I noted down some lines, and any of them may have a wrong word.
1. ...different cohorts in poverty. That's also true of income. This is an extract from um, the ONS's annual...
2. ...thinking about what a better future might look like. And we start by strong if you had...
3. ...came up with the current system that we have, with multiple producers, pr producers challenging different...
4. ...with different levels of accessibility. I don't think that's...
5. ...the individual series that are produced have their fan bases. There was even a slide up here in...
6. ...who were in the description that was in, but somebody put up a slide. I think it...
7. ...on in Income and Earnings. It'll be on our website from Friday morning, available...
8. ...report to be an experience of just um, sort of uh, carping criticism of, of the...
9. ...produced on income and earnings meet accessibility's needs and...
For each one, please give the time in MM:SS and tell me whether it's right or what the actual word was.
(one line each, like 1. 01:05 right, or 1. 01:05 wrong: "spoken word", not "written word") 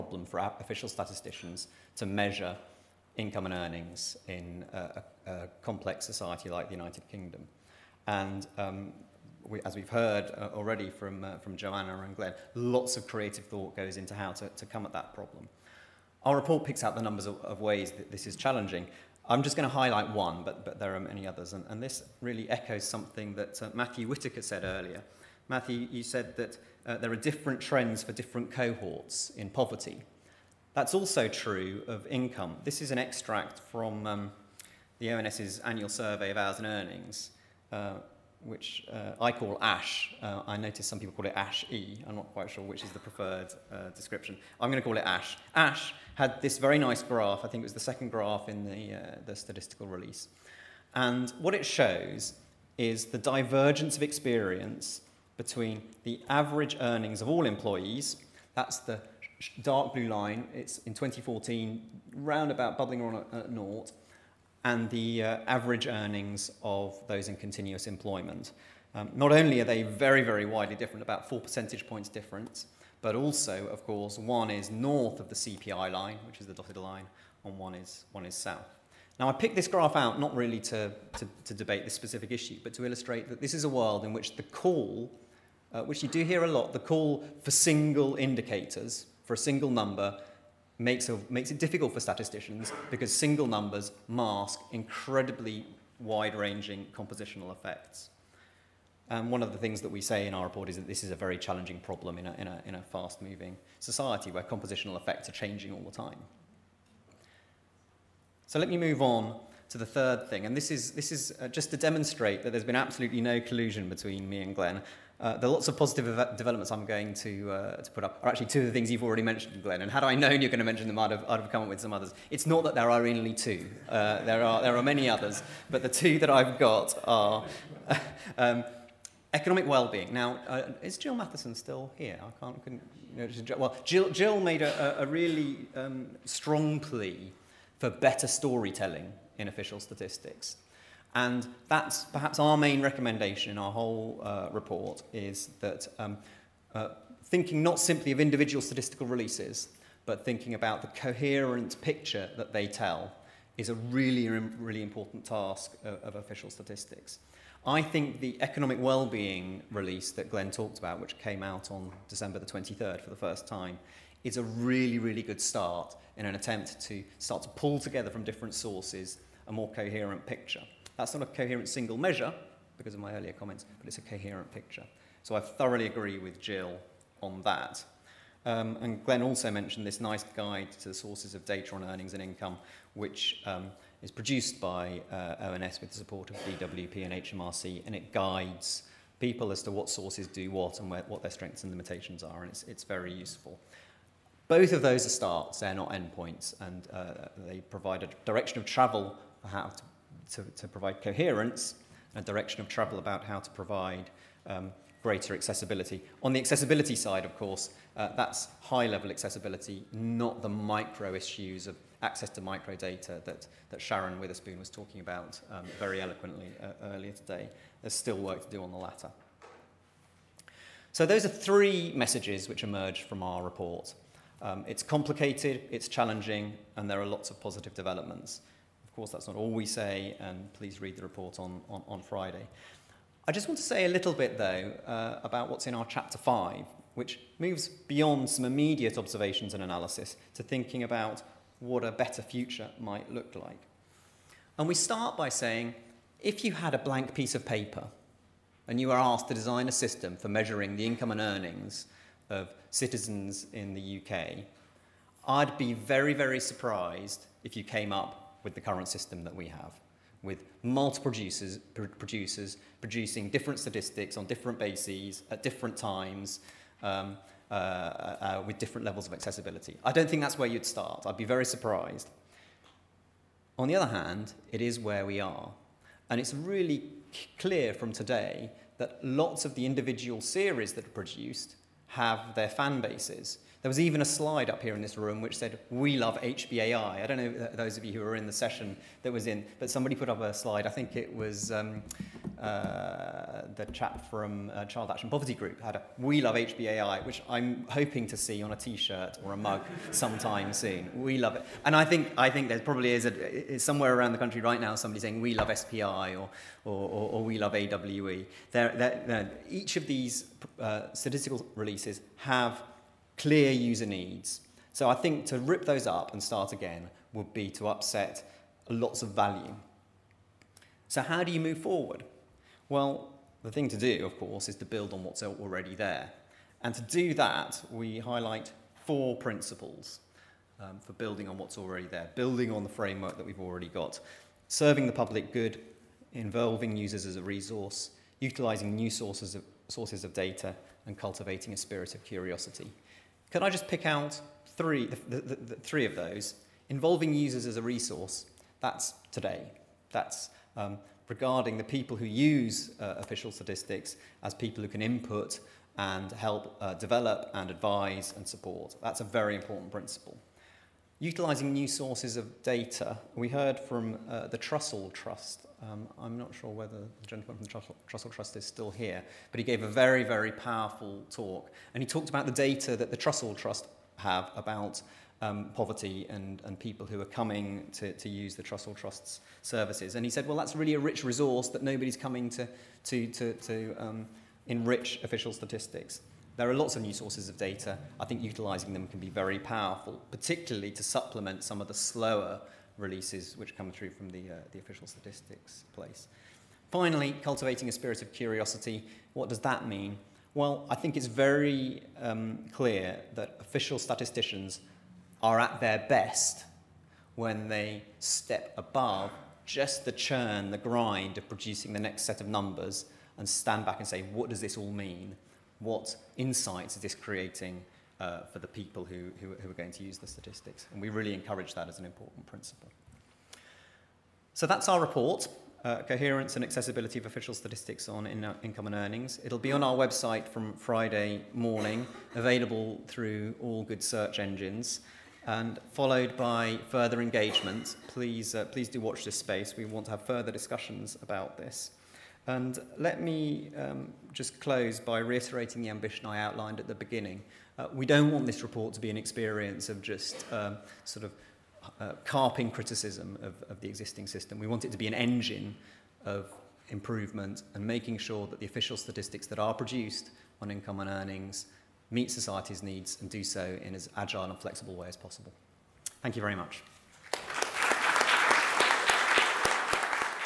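1. 00:28 right
2. 04:00 wrong: "saying", not "strong"
3. 04:17 wrong: "producing", not "challenging"
4. 04:28 right
5. 04:39 right
6. 04:47 wrong: "session", not "description"
7. 07:07 right
8. 07:28 right
9. 07:39 wrong: "society", not "accessibility".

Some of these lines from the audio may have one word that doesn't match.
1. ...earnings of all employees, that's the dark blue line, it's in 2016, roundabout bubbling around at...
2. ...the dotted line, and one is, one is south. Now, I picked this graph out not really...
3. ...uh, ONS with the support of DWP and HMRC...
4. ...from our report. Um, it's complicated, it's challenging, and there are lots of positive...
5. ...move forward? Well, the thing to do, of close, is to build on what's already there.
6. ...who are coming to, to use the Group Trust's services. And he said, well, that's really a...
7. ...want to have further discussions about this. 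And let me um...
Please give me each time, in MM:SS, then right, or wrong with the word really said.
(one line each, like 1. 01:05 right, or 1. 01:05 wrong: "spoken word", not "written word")
1. 00:56 wrong: "2014", not "2016"
2. 01:16 right
3. 03:05 right
4. 03:43 right
5. 05:21 wrong: "course", not "close"
6. 06:16 wrong: "Trussell", not "Group"
7. 07:19 right.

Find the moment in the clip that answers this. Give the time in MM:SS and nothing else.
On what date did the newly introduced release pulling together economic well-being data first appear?
02:42.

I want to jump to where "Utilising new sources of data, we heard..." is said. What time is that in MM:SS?
06:00.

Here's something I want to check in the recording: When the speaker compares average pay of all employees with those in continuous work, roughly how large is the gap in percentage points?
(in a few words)
4 percentage points.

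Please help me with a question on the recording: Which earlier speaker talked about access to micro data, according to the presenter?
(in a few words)
Sharon Witherspoon.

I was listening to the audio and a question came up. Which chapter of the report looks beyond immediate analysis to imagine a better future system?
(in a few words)
Chapter 5.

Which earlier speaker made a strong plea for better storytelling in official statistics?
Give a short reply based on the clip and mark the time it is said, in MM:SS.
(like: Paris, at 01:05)
Jil Matheson, at 02:10.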